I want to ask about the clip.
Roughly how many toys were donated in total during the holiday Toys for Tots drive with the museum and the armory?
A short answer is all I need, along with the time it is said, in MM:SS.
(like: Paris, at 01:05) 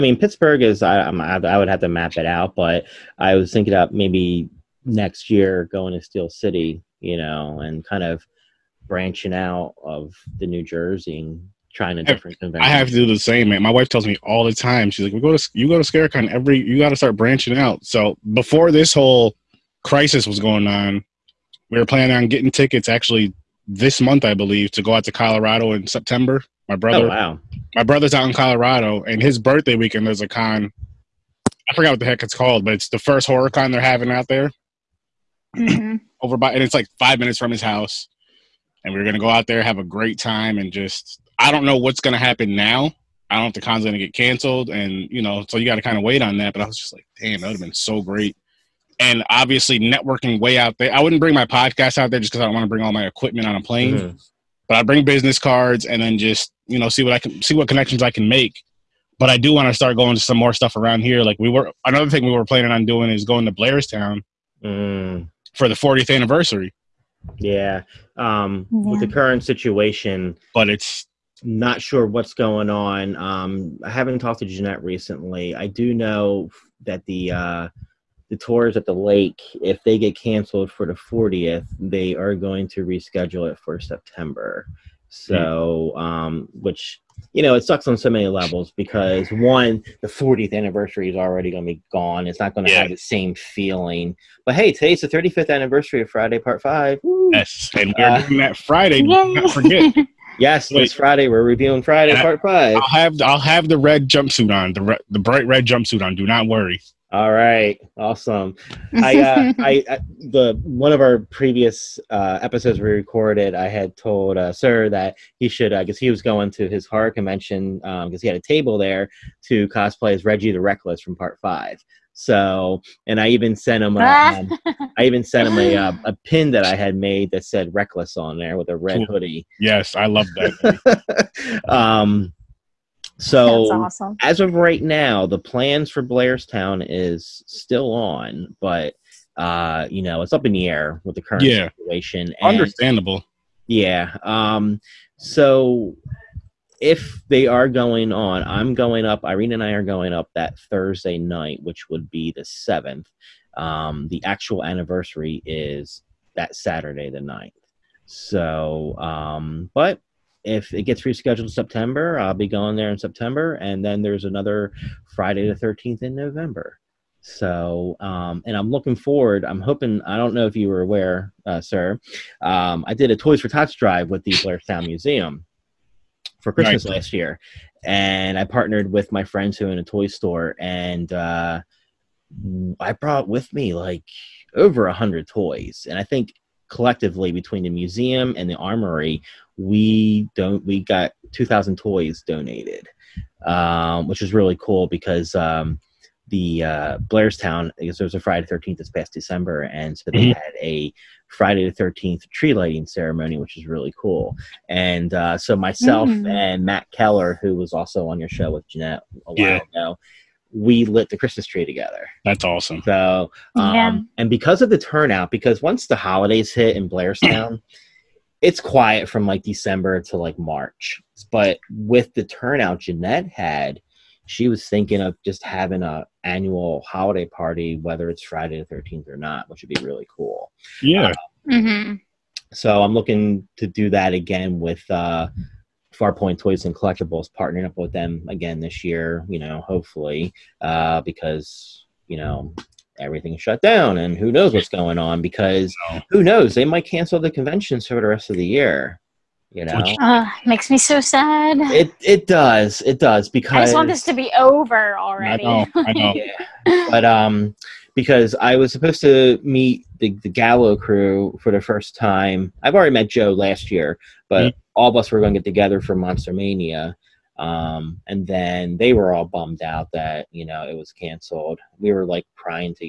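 2,000, at 03:11.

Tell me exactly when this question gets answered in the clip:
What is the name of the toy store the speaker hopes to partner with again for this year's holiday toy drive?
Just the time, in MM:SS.
03:55.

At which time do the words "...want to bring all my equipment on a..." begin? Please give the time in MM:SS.
00:52.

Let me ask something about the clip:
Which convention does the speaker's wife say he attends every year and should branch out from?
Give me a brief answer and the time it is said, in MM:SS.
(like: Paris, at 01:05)
Scarecon, at 00:15.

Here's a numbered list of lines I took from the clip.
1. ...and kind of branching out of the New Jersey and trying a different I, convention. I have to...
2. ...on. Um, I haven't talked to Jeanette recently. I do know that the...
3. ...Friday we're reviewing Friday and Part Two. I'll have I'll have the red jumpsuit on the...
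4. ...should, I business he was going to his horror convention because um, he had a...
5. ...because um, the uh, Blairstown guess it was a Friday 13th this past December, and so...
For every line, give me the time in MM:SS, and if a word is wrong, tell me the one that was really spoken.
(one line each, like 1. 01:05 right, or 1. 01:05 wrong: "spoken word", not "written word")
1. 00:07 right
2. 01:12 right
3. 01:40 wrong: "Five", not "Two"
4. 01:55 wrong: "guess", not "business"
5. 03:14 right.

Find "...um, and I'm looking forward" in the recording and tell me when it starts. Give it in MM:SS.
02:47.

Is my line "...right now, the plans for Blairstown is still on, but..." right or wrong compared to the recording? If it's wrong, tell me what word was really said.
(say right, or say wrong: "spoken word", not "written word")
right.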